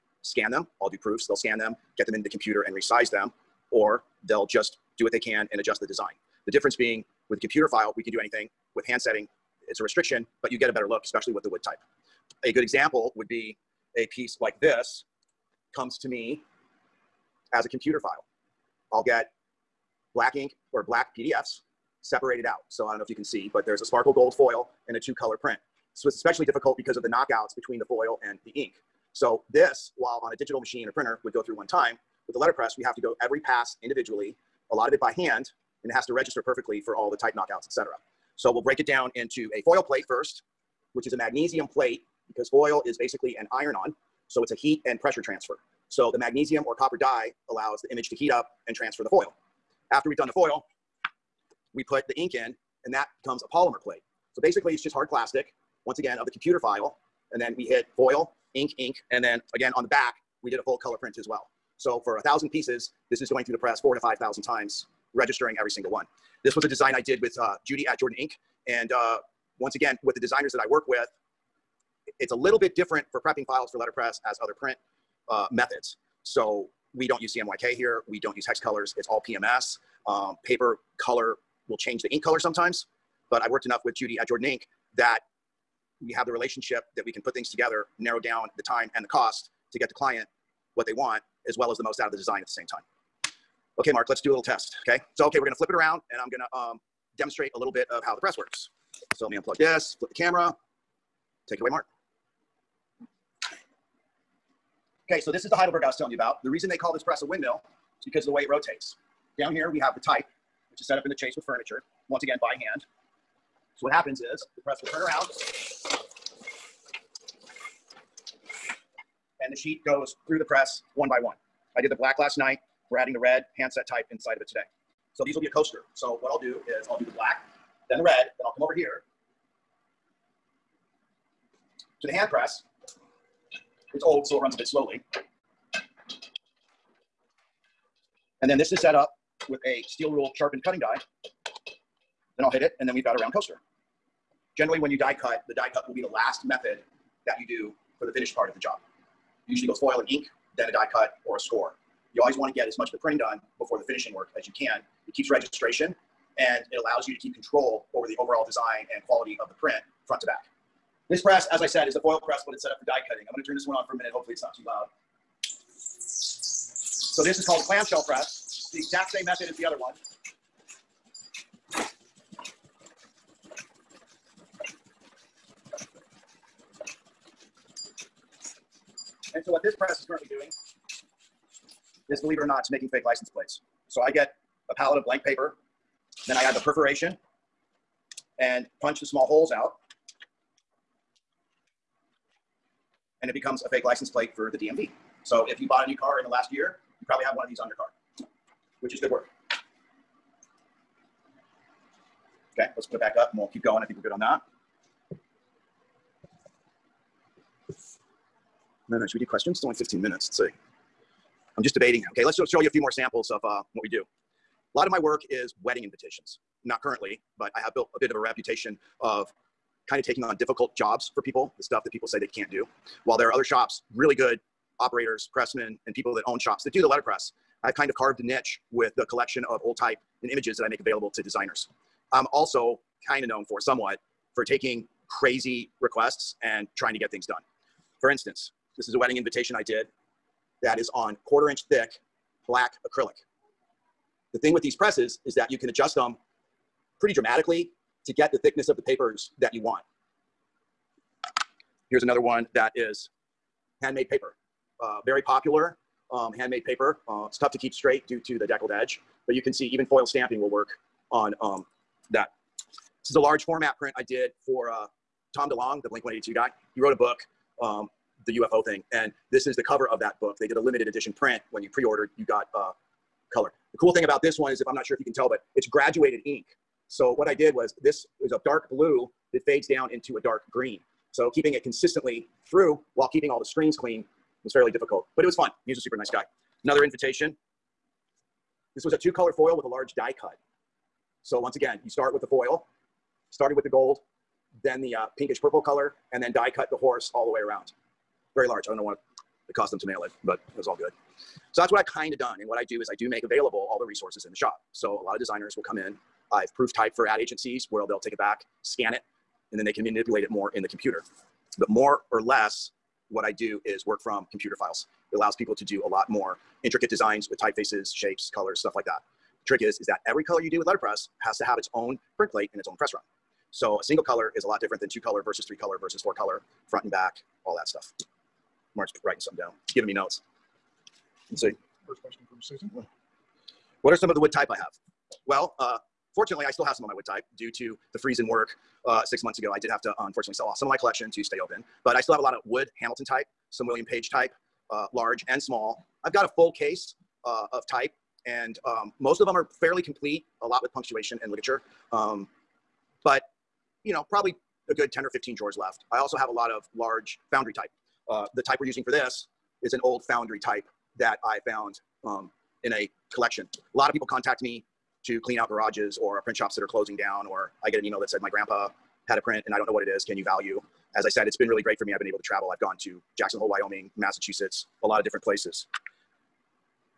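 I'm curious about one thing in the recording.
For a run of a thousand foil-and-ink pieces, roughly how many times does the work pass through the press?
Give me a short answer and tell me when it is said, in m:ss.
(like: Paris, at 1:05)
4,000 to 5,000, at 1:03.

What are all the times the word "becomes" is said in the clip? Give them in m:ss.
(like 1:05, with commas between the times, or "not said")
0:53, 3:13.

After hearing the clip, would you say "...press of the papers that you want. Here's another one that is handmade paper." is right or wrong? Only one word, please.
wrong.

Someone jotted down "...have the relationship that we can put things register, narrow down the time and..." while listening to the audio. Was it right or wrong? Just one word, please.
wrong.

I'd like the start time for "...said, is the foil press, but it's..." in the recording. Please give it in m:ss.
2:41.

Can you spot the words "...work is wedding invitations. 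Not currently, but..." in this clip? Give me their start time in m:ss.
3:34.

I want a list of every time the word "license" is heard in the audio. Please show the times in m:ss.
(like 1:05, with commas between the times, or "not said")
3:03, 3:13.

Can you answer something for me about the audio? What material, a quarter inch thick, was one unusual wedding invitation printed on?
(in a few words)
Black acrylic.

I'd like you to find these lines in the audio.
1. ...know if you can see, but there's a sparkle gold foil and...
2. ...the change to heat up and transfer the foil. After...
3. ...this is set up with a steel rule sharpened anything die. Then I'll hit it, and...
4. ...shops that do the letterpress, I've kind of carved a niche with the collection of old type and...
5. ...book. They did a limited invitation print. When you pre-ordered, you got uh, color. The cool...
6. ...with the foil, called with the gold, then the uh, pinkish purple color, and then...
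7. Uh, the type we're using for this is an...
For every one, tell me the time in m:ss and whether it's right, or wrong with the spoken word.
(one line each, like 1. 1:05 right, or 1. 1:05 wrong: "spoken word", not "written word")
1. 0:22 right
2. 0:47 wrong: "image", not "change"
3. 2:18 wrong: "cutting", not "anything"
4. 3:46 right
5. 4:30 wrong: "edition", not "invitation"
6. 4:52 wrong: "started", not "called"
7. 5:58 right.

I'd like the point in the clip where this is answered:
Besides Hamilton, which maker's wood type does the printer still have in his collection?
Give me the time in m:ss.
5:43.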